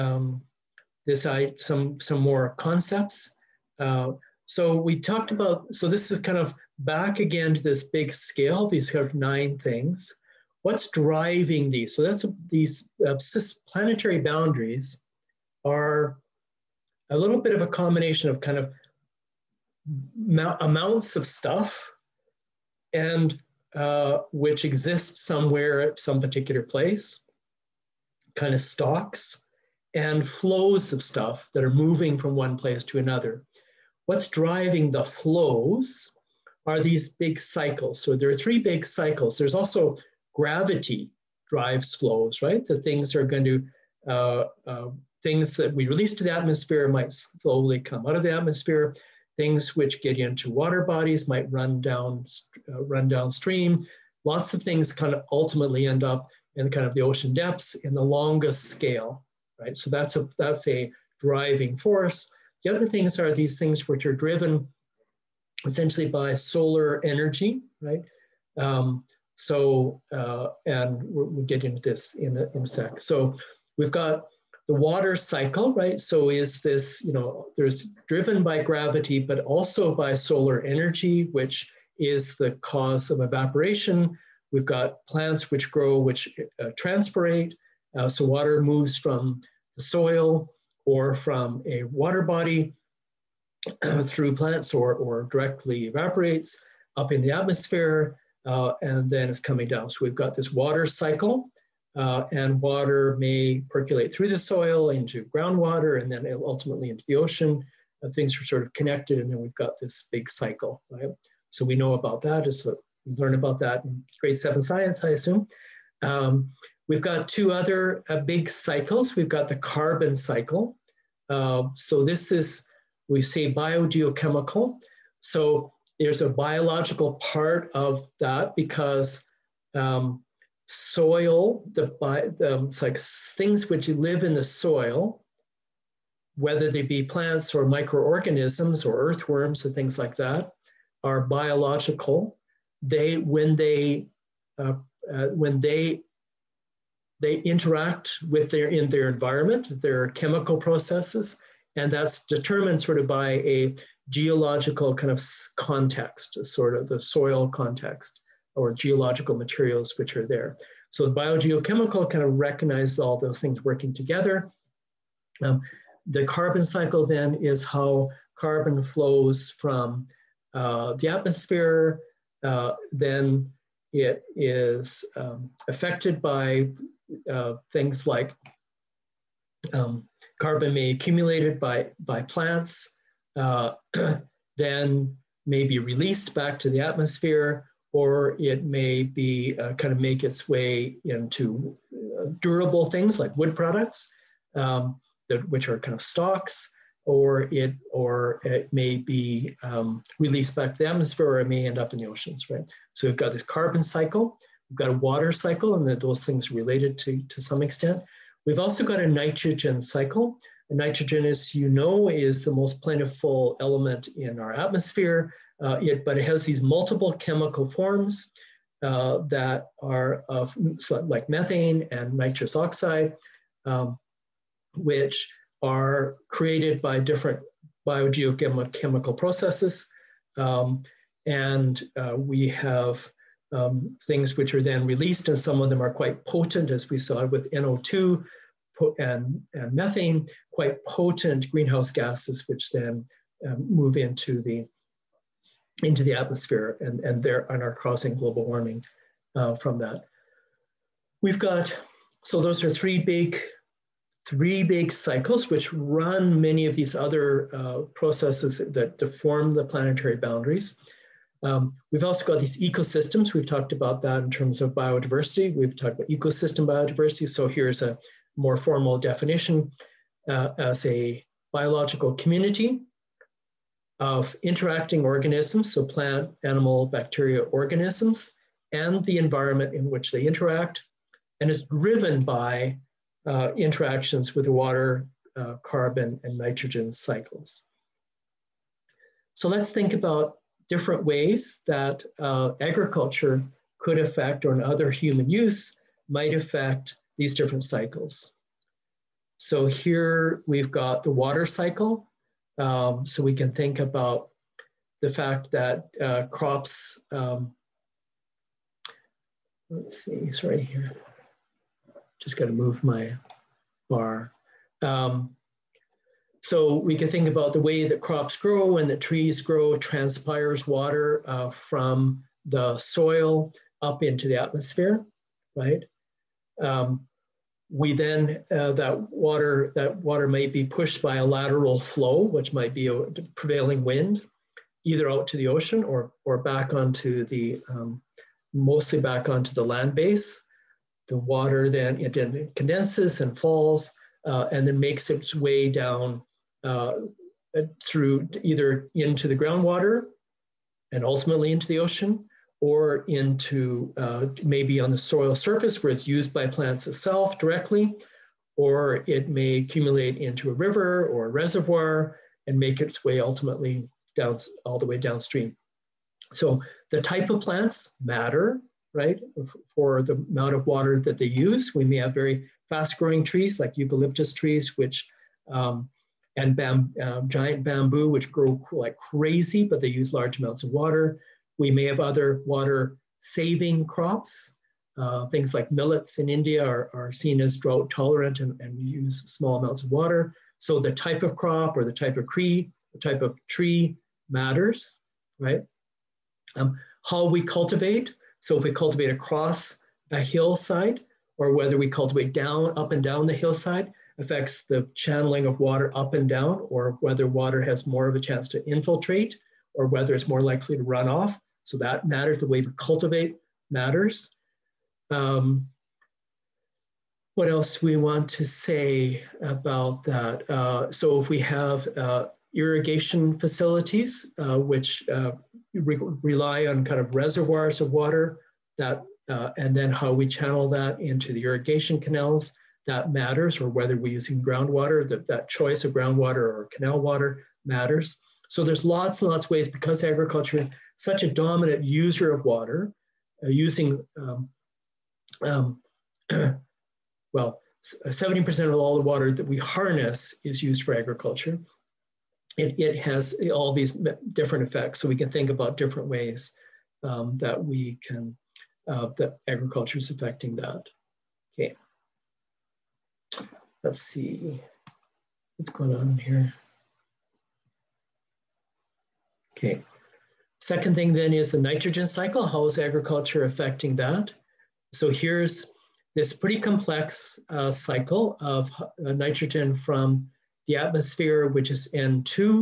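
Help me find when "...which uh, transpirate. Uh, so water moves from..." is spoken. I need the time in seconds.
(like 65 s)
85 s.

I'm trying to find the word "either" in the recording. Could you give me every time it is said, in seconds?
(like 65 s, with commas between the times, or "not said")
334 s, 348 s.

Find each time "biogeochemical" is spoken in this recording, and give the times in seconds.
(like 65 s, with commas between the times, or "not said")
123 s, 161 s, 227 s.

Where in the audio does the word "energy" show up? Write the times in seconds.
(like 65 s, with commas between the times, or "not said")
67 s, 80 s.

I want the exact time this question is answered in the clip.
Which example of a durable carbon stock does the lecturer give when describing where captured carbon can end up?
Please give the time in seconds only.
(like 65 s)
193 s.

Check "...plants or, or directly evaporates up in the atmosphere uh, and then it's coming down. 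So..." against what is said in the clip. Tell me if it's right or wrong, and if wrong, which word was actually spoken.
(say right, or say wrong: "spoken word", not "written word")
right.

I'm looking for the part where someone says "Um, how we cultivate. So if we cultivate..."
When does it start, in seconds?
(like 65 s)
396 s.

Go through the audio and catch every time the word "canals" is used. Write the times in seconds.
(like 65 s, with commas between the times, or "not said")
431 s, 436 s.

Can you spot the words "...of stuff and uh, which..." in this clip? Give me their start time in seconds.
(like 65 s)
21 s.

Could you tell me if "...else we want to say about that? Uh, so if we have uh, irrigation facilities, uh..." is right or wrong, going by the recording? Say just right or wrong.
right.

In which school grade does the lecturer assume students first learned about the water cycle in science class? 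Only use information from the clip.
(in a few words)
Grade 7.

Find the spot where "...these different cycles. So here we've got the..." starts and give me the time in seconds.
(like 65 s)
297 s.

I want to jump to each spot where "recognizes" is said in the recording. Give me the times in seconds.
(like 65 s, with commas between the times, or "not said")
162 s.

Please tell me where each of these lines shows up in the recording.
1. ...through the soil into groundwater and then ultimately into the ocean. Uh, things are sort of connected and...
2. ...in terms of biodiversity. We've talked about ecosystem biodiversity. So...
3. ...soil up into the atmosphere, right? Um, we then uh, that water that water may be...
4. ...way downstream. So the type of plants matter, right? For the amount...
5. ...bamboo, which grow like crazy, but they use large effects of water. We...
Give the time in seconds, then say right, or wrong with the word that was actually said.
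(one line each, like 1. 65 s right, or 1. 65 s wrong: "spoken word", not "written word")
1. 104 s right
2. 264 s right
3. 322 s right
4. 364 s right
5. 377 s wrong: "amounts", not "effects".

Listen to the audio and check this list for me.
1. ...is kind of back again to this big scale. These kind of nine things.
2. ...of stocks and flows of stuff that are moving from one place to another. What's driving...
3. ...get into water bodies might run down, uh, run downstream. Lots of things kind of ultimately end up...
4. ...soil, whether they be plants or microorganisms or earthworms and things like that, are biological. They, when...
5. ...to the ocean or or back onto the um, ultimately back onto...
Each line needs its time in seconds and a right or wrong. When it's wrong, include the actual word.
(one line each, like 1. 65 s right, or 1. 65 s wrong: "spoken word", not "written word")
1. 6 s right
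2. 28 s right
3. 50 s right
4. 134 s right
5. 335 s wrong: "mostly", not "ultimately".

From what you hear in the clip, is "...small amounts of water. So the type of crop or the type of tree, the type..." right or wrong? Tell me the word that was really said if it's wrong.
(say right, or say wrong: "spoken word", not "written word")
right.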